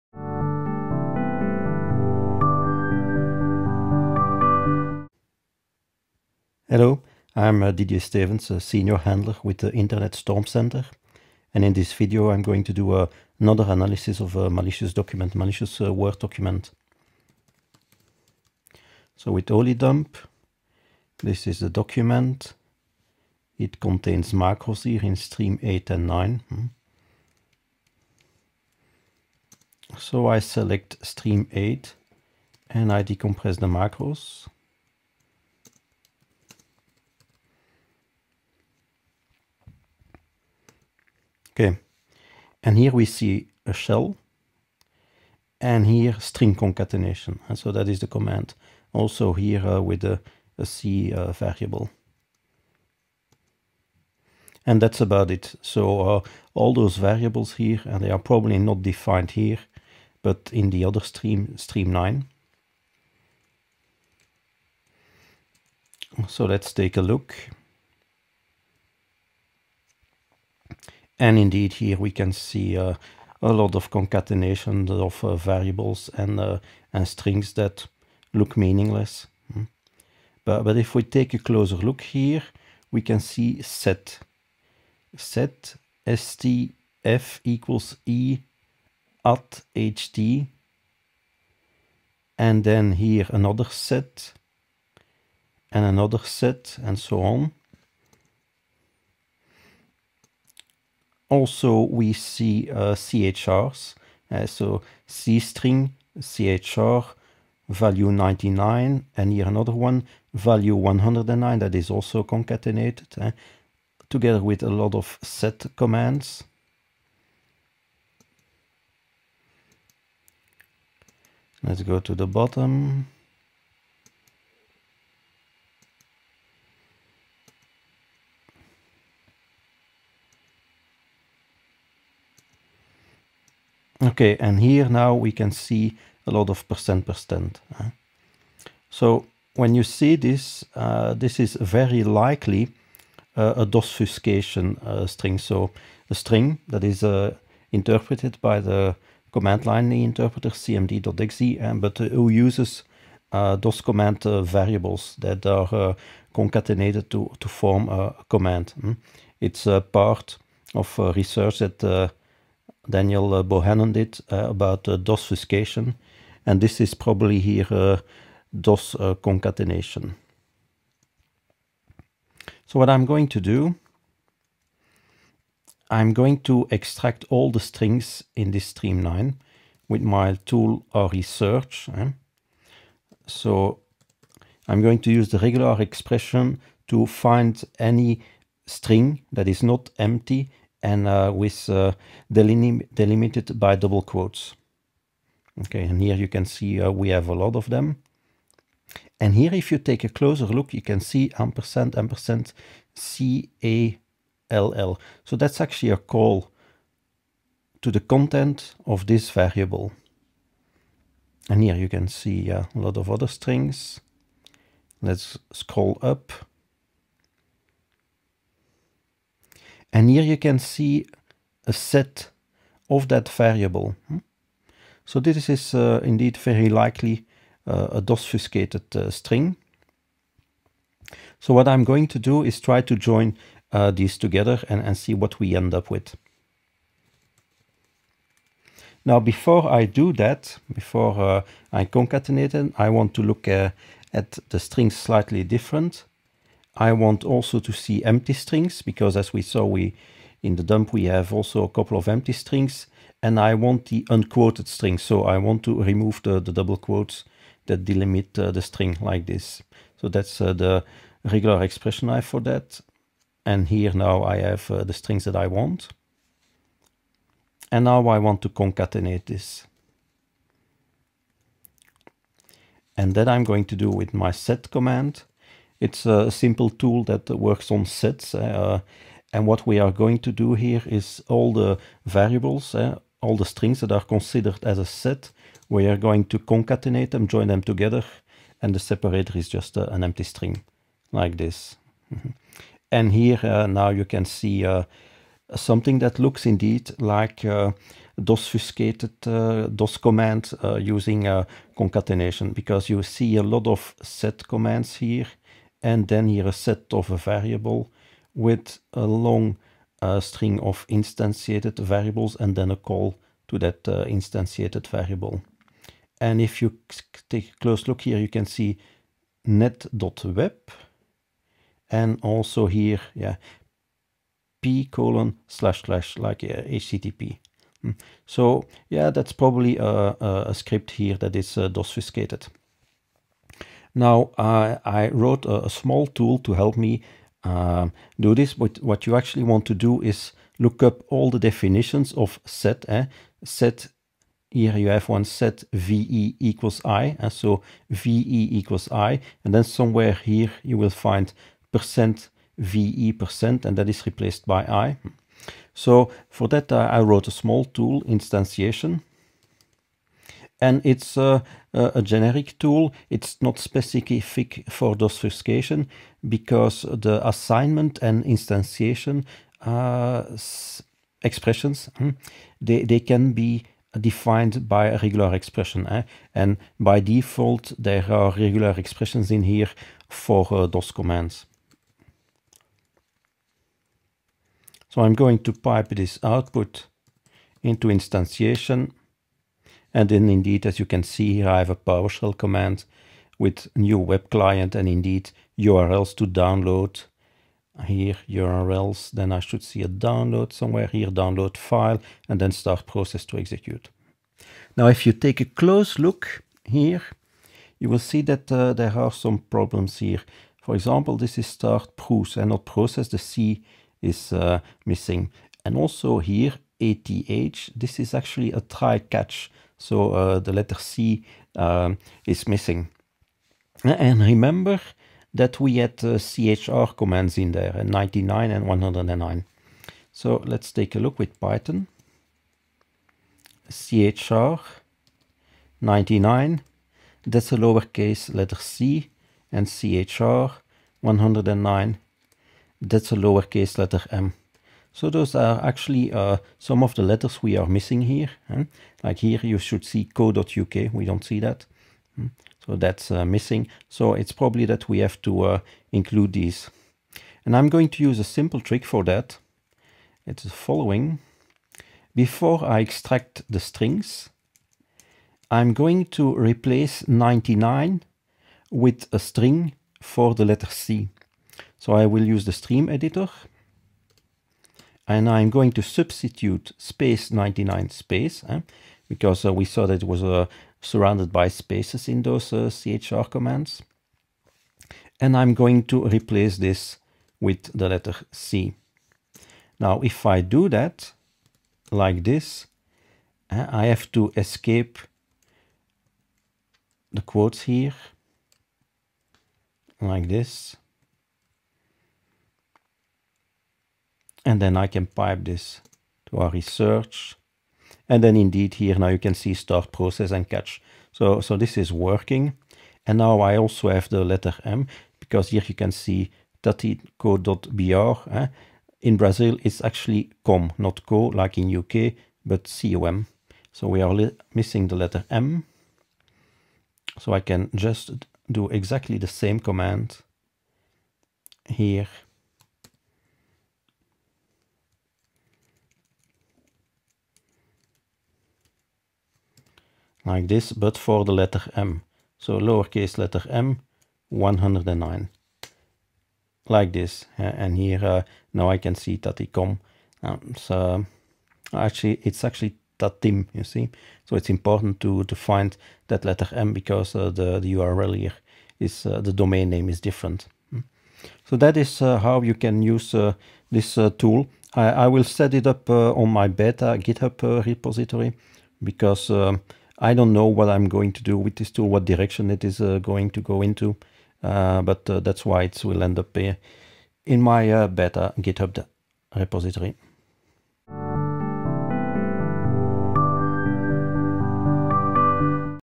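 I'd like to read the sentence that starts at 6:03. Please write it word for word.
It's not specific for DOSfuscation because the assignment and instantiation uh, expressions, hmm, they, they can be defined by a regular expression.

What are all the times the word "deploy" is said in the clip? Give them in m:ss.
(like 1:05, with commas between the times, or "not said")
not said.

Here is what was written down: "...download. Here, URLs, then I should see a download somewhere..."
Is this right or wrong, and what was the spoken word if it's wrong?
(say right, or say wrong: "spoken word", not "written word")
right.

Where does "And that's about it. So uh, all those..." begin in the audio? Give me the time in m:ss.
0:54.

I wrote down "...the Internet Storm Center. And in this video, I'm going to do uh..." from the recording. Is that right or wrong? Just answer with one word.
right.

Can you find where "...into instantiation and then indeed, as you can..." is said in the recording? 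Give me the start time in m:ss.
6:27.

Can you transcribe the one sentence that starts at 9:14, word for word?
So it's important to, to find that letter M because uh, the, the URL here is, uh, the domain name is different.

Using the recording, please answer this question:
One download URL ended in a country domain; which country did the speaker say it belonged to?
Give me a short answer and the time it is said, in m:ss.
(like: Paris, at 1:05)
Brazil, at 8:39.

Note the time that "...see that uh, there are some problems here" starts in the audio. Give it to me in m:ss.
6:47.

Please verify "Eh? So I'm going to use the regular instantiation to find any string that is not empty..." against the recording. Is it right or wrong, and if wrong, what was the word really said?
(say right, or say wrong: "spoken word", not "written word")
wrong: "expression", not "instantiation".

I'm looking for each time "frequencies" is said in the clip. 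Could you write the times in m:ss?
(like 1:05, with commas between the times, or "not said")
not said.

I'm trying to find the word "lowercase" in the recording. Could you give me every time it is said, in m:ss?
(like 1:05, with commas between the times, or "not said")
7:17, 7:23, 9:02.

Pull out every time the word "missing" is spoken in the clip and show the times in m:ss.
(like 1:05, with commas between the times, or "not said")
6:54, 7:02, 7:27, 7:33, 8:44.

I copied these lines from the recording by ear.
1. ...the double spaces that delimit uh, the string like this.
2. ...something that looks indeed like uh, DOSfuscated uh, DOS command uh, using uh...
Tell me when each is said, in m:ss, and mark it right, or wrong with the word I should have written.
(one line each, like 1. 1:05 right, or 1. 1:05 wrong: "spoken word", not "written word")
1. 4:16 wrong: "quotes", not "spaces"
2. 4:55 right.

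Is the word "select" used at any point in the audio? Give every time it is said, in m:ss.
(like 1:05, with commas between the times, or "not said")
0:30.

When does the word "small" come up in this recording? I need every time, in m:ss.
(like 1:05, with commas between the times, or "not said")
5:35, 5:57.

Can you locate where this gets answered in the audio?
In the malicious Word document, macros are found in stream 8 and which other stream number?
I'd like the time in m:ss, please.
1:01.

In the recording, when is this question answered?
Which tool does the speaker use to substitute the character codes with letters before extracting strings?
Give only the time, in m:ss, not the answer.
7:52.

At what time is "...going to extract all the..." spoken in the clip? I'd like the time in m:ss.
2:56.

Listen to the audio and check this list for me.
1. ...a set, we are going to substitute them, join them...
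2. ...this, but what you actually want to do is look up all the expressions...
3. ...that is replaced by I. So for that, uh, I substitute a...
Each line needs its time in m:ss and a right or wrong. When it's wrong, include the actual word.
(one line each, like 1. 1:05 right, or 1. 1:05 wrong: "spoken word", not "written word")
1. 4:44 wrong: "concatenate", not "substitute"
2. 5:38 wrong: "definitions", not "expressions"
3. 5:53 wrong: "wrote", not "substitute".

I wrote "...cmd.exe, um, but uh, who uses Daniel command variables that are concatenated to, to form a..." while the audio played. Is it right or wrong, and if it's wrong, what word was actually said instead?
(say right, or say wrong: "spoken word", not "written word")
wrong: "DOS", not "Daniel".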